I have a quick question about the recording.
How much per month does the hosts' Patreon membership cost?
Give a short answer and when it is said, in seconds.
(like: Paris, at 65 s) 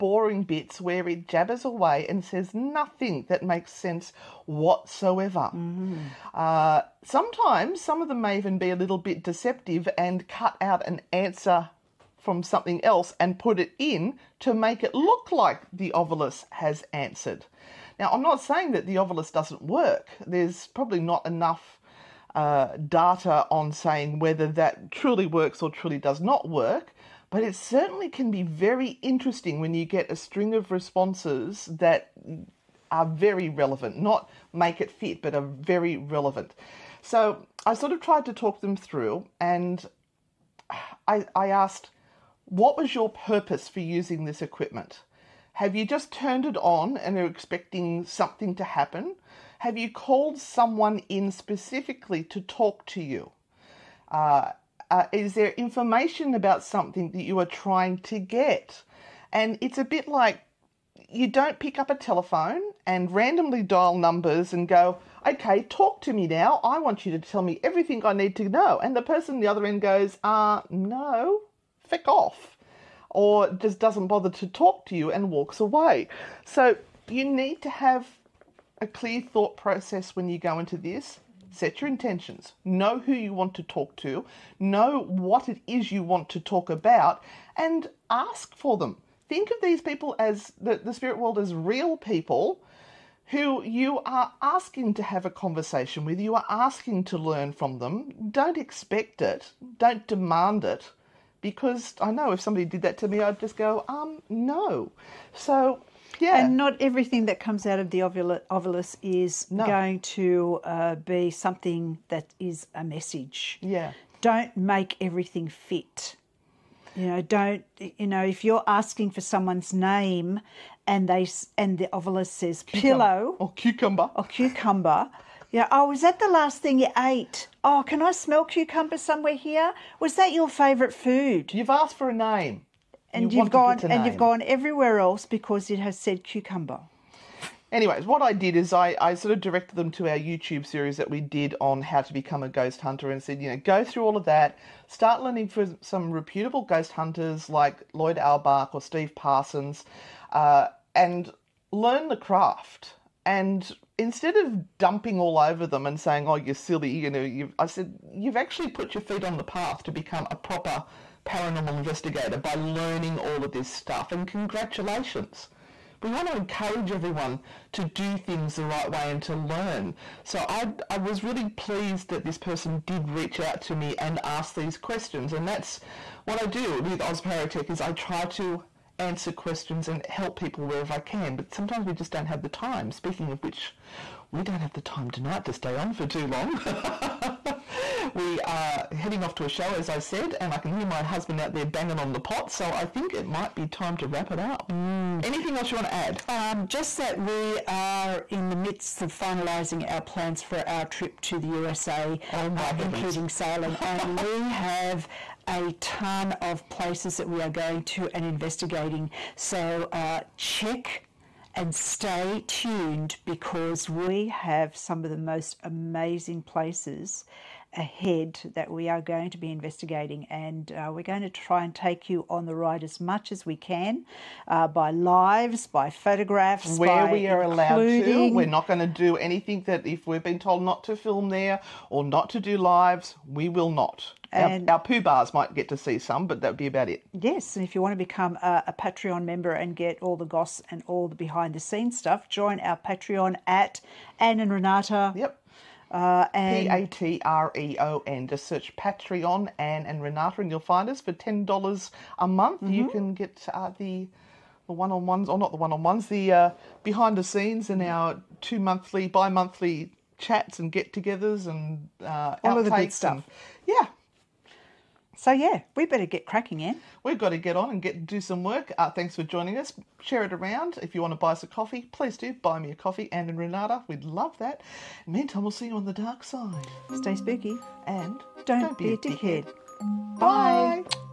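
$10, at 251 s.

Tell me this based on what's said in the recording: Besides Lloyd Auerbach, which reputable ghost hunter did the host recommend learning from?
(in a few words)
Steve Parsons.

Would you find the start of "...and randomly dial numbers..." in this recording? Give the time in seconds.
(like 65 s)
62 s.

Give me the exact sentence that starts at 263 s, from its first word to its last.
And, yeah, so yeah, we better get cracking in.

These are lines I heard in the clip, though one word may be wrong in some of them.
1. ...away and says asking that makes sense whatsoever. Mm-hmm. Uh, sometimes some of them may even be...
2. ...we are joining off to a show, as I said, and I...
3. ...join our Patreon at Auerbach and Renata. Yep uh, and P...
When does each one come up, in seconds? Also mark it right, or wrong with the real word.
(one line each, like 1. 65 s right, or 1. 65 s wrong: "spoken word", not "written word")
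1. 1 s wrong: "nothing", not "asking"
2. 188 s wrong: "heading", not "joining"
3. 242 s wrong: "Anne", not "Auerbach".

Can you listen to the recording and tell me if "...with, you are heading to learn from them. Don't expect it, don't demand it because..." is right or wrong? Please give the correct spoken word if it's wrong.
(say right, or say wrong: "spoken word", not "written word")
wrong: "asking", not "heading".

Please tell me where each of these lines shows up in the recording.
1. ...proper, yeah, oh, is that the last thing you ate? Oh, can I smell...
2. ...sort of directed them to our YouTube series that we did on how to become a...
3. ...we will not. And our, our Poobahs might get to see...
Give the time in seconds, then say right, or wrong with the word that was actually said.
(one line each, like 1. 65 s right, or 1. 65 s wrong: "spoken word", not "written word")
1. 124 s wrong: "cucumber", not "proper"
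2. 139 s right
3. 233 s right.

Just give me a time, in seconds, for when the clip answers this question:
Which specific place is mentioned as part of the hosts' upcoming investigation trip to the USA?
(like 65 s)
203 s.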